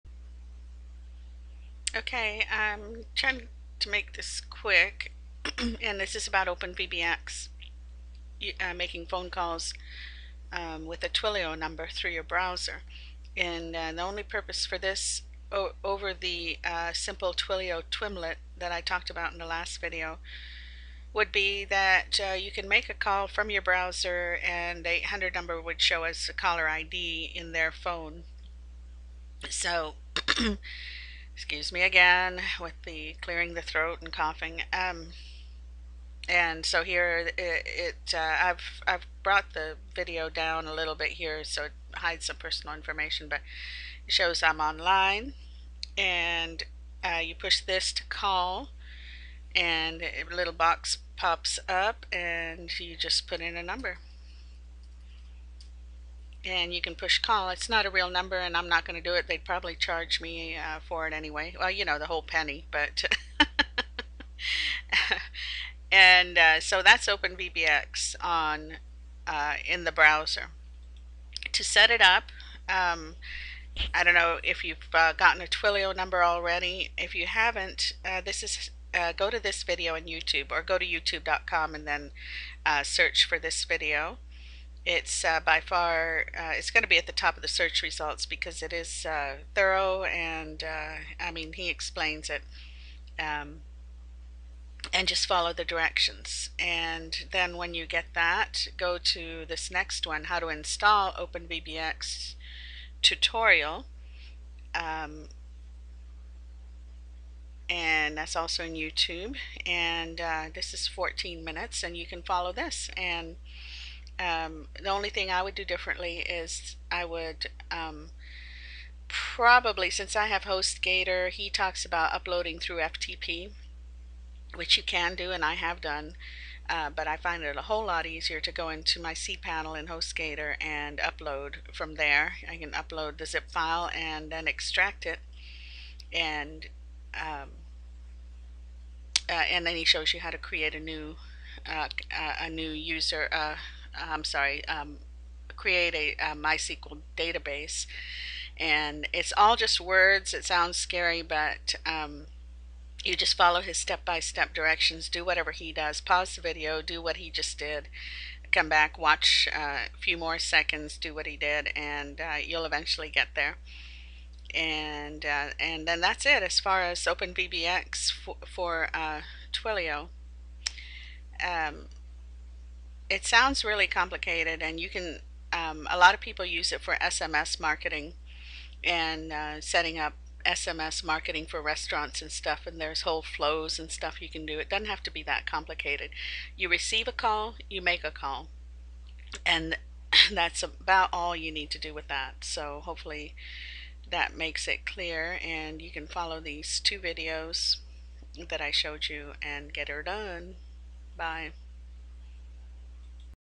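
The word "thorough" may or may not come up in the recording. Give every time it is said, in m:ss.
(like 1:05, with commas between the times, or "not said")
1:29.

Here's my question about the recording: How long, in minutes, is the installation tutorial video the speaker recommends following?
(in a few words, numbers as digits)
14 minutes.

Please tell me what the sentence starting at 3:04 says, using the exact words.
It doesn't have to be that complicated.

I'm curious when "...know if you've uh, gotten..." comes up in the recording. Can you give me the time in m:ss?
1:14.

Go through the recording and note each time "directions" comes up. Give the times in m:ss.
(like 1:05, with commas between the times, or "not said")
1:35, 2:34.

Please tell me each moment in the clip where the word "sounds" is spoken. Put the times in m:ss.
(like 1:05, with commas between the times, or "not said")
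2:30, 2:53.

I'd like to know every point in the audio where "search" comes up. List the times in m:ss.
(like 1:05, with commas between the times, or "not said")
1:22, 1:27.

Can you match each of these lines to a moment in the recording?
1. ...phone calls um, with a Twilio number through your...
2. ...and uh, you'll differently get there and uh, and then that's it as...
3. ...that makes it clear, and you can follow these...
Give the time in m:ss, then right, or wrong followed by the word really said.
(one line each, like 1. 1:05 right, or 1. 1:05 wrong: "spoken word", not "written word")
1. 0:09 right
2. 2:41 wrong: "eventually", not "differently"
3. 3:14 right.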